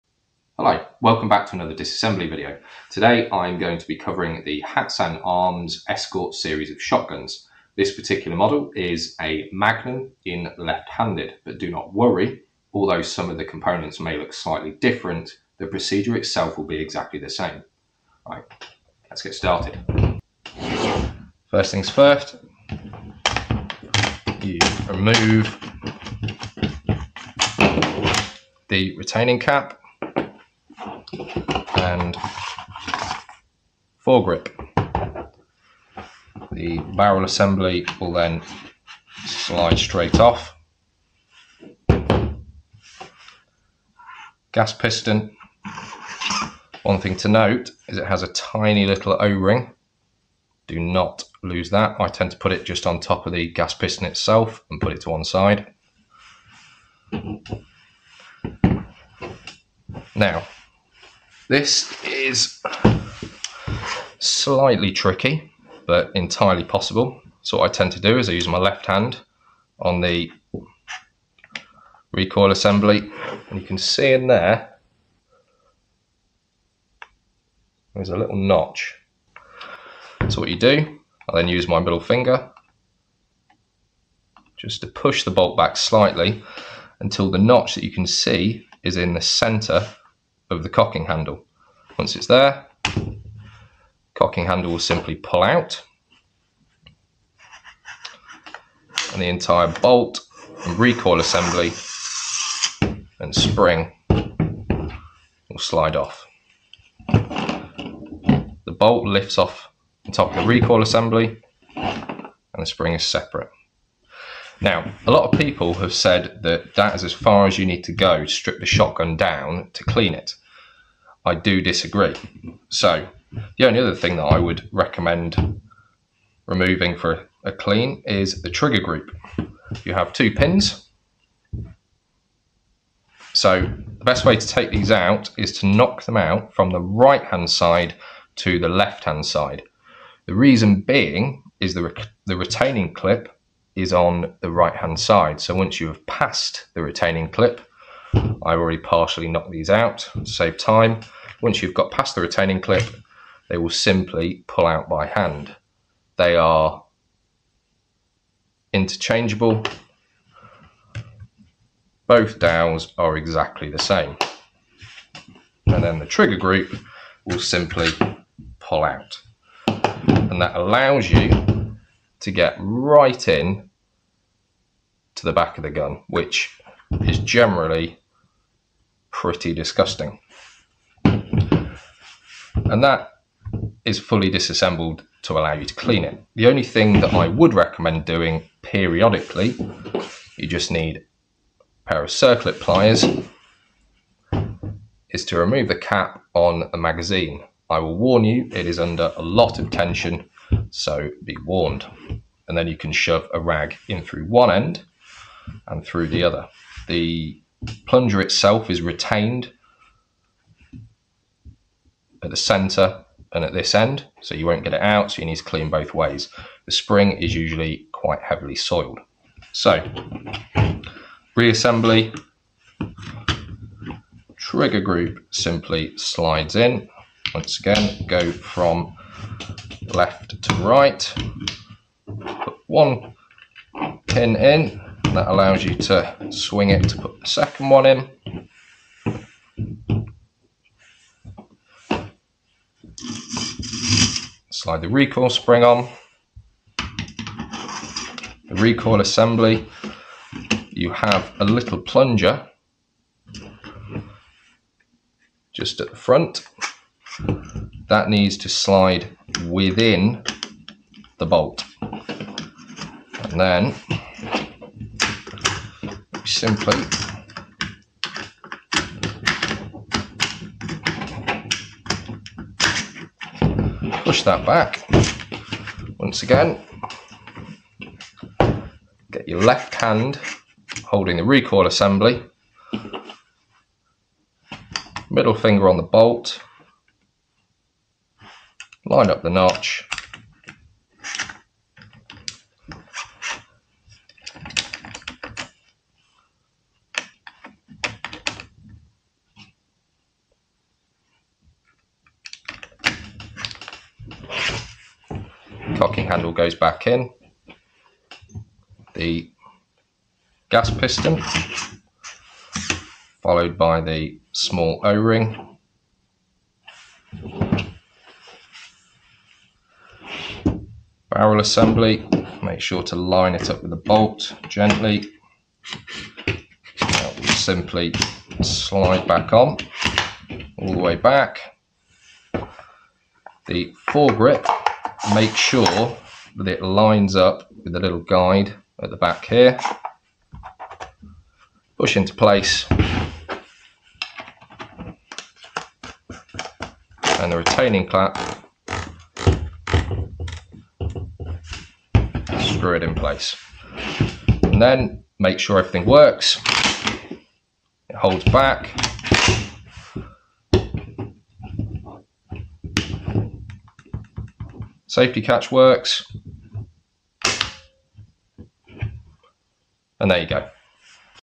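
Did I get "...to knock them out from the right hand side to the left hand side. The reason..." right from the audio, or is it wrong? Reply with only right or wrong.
right.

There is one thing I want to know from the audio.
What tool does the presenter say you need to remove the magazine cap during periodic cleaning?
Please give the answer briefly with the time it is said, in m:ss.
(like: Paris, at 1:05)
circlip pliers, at 3:12.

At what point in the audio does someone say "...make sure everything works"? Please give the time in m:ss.
5:55.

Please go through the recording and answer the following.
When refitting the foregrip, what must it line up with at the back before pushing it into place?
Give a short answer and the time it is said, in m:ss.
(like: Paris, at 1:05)
the little guide, at 5:37.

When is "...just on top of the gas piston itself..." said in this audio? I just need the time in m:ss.
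0:52.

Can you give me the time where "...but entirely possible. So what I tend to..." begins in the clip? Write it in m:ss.
1:05.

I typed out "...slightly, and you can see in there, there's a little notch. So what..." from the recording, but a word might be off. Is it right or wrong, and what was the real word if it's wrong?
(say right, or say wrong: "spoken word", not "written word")
wrong: "assembly", not "slightly".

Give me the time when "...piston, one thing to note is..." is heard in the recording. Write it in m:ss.
0:44.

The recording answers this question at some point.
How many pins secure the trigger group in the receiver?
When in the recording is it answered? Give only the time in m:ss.
2:10.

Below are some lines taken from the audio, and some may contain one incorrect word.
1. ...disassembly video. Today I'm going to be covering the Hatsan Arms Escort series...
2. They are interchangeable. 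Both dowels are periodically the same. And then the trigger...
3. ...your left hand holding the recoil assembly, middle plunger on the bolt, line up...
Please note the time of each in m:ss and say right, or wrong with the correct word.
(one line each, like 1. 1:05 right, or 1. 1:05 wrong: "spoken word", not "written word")
1. 0:01 right
2. 2:36 wrong: "exactly", not "periodically"
3. 4:39 wrong: "finger", not "plunger".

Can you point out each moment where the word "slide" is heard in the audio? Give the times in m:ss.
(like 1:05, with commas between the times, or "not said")
0:39, 1:45, 3:45, 4:04, 4:18, 5:28.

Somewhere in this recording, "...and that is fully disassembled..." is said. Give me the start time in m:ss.
3:02.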